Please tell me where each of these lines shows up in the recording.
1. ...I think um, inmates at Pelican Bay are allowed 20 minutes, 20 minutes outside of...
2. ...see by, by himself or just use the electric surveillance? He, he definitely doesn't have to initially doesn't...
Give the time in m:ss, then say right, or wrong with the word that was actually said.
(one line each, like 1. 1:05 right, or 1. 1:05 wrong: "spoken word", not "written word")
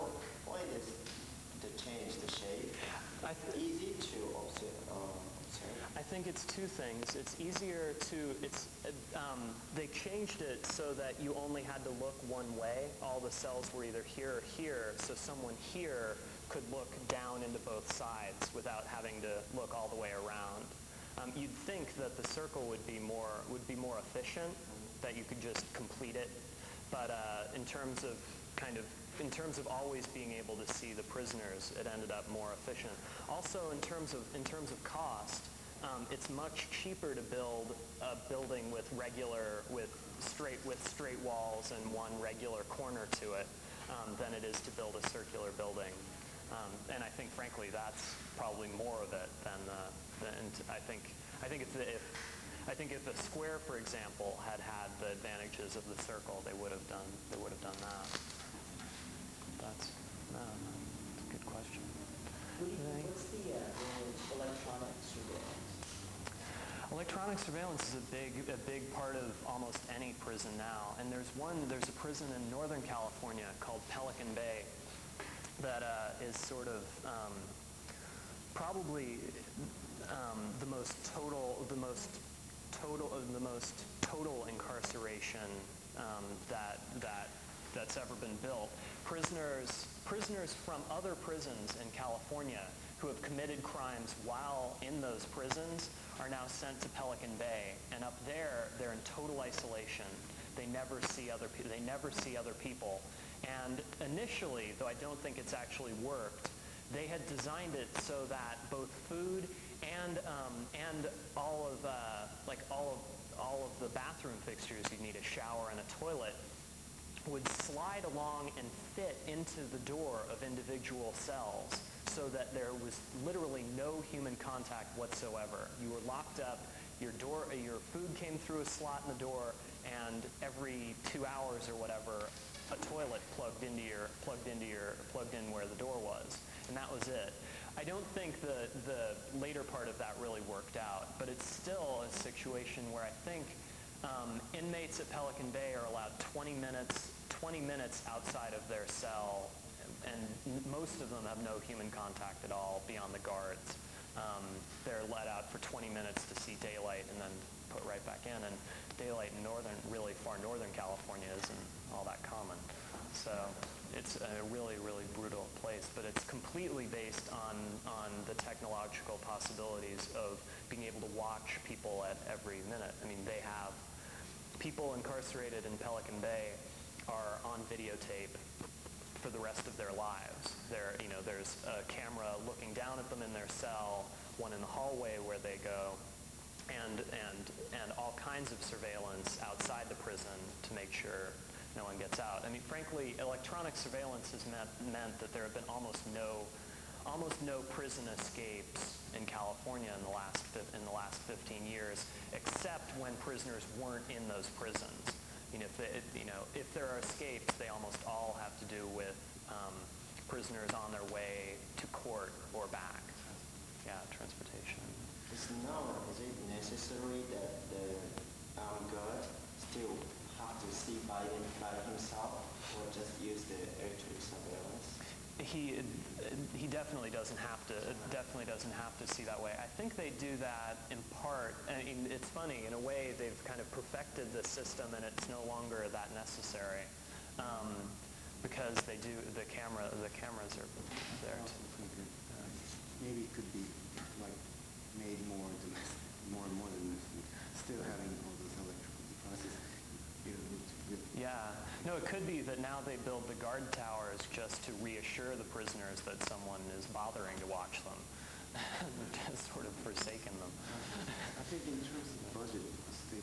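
1. 2:23 right
2. 3:40 wrong: "definitely", not "initially".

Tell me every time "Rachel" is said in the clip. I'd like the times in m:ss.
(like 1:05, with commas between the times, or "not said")
not said.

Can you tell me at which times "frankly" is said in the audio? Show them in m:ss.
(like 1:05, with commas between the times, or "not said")
0:47, 3:12.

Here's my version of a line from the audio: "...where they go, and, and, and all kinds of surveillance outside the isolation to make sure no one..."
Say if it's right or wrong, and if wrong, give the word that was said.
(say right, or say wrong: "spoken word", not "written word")
wrong: "prison", not "isolation".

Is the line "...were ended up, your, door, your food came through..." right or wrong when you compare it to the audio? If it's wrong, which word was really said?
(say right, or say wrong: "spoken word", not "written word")
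wrong: "locked", not "ended".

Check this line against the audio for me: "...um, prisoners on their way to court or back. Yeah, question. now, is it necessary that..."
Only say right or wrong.
wrong.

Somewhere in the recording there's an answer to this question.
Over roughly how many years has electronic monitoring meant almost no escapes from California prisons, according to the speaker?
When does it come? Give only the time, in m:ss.
3:21.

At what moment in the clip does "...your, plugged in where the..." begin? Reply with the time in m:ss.
2:14.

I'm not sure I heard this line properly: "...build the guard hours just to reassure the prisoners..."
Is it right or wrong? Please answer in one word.
wrong.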